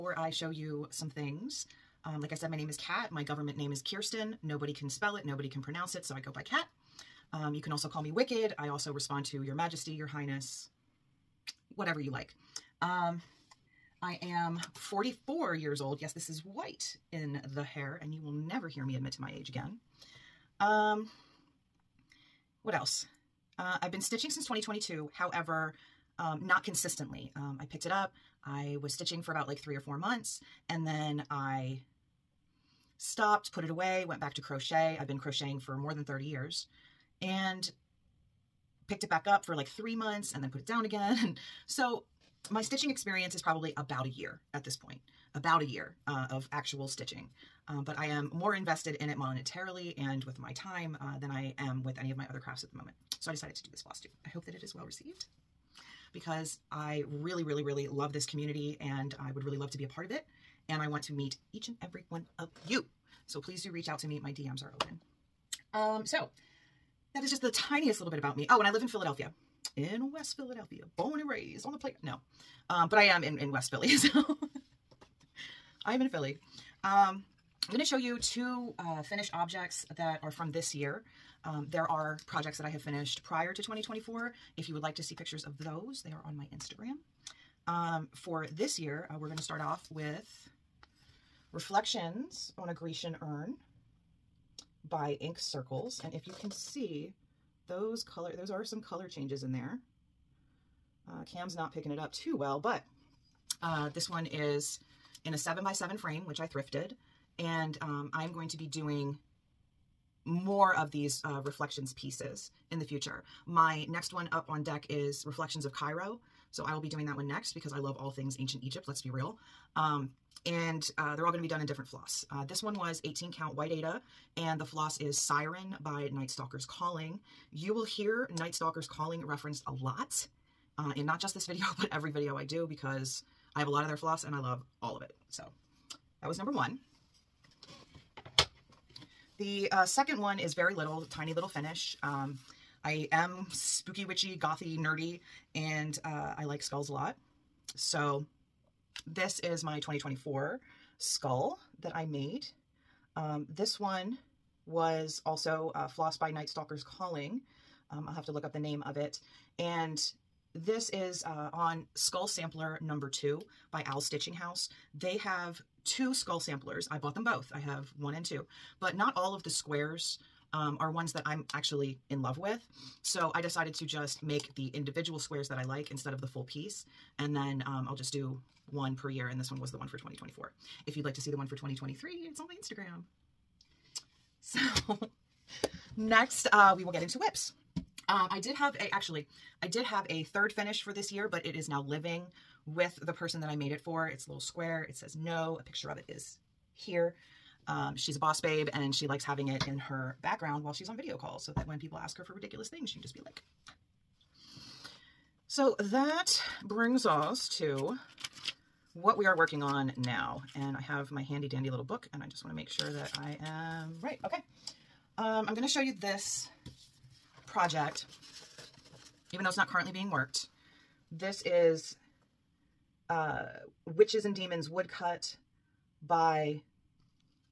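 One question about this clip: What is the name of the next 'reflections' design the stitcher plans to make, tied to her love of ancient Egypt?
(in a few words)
Reflections of Cairo.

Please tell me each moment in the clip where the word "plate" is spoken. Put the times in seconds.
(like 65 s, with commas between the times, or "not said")
71 s.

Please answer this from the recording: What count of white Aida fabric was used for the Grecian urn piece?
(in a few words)
18 count.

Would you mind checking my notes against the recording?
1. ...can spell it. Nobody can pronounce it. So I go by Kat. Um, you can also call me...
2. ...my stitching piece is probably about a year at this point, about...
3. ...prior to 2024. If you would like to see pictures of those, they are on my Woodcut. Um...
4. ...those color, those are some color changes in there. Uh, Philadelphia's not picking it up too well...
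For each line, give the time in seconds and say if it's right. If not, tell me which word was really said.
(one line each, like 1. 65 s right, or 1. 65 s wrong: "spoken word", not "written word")
1. 4 s right
2. 42 s wrong: "experience", not "piece"
3. 83 s wrong: "Instagram", not "Woodcut"
4. 97 s wrong: "Cam", not "Philadelphia".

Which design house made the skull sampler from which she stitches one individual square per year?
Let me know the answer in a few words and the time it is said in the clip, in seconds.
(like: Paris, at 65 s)
Al Stitching House, at 163 s.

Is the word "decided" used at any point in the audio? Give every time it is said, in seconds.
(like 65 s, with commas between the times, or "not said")
53 s, 173 s.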